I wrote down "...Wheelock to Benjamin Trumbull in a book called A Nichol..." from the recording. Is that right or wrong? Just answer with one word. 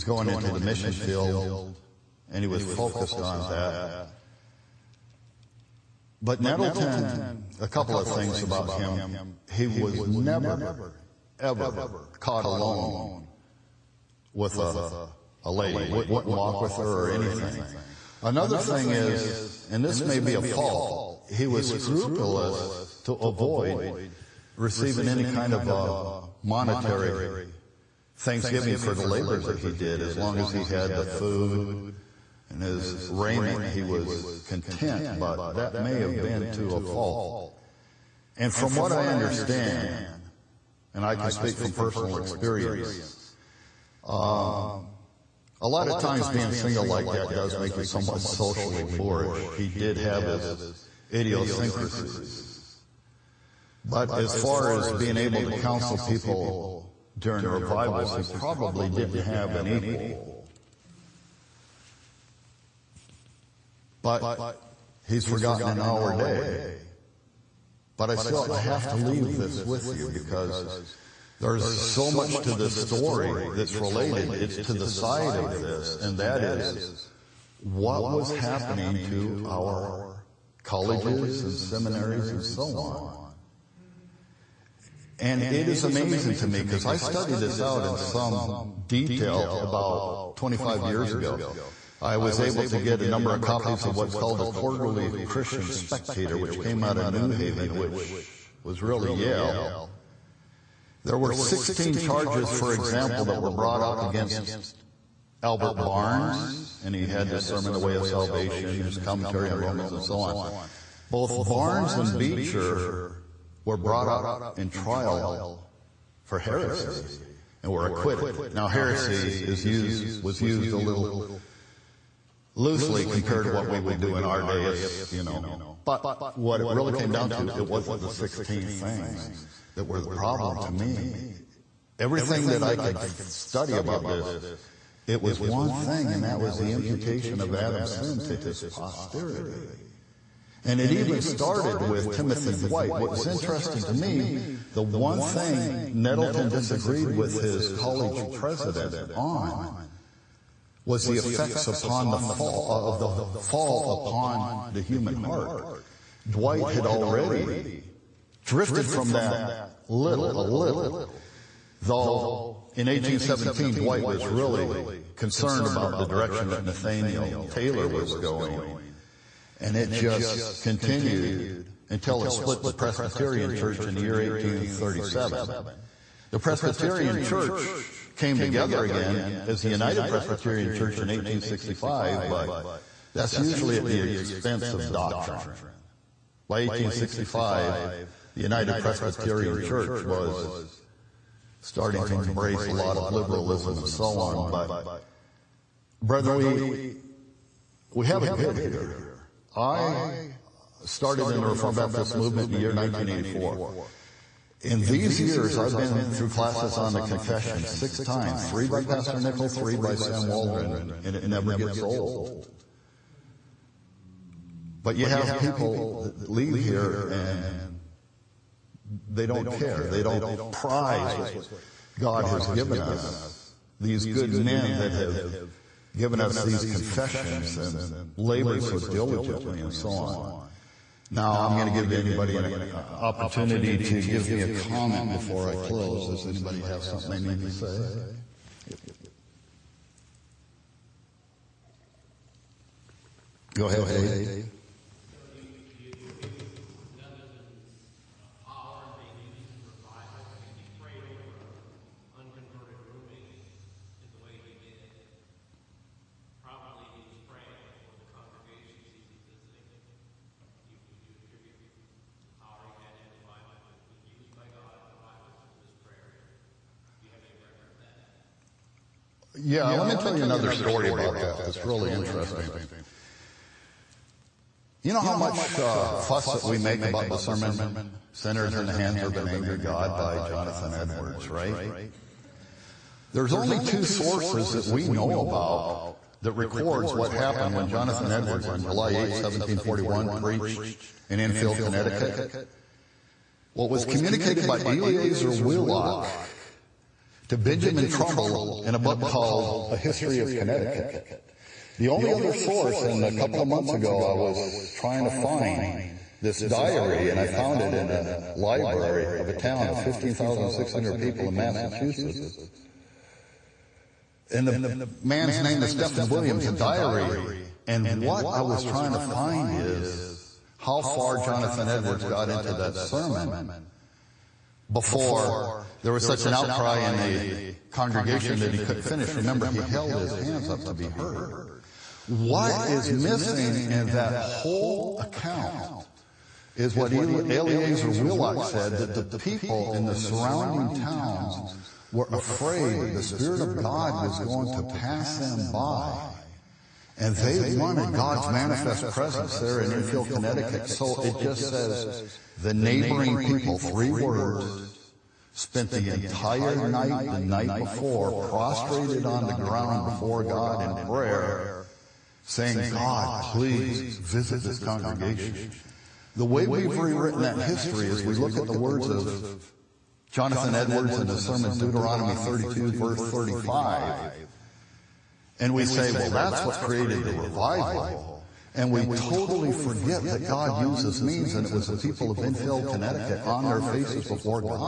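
wrong.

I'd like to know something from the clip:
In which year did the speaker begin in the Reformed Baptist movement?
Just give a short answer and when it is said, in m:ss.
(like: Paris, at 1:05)
1984, at 3:22.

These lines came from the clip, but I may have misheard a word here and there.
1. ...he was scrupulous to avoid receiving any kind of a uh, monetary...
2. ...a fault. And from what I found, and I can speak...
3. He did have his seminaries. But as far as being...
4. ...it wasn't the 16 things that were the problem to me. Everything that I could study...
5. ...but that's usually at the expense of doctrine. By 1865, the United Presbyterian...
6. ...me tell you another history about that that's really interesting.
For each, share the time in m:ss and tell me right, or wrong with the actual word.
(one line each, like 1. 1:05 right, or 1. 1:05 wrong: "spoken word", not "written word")
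1. 0:21 right
2. 0:36 wrong: "understand", not "found"
3. 0:49 wrong: "idiosyncrasies", not "seminaries"
4. 2:07 right
5. 3:02 right
6. 4:29 wrong: "story", not "history".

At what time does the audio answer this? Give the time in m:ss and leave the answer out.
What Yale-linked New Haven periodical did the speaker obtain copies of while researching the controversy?
1:34.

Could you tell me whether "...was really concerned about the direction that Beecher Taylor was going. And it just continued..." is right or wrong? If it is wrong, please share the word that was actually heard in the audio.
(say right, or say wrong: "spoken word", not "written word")
wrong: "Nathaniel", not "Beecher".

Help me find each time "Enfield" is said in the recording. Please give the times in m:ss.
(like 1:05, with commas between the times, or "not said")
4:51, 5:49, 6:22.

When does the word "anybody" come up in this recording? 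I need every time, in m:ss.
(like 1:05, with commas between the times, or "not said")
3:51, 3:56.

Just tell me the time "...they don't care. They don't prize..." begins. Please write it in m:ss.
3:39.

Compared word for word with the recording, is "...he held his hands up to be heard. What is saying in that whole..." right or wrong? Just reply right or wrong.
wrong.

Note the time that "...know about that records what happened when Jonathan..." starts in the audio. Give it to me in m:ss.
4:44.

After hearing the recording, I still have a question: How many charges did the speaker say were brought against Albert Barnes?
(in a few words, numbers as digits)
16.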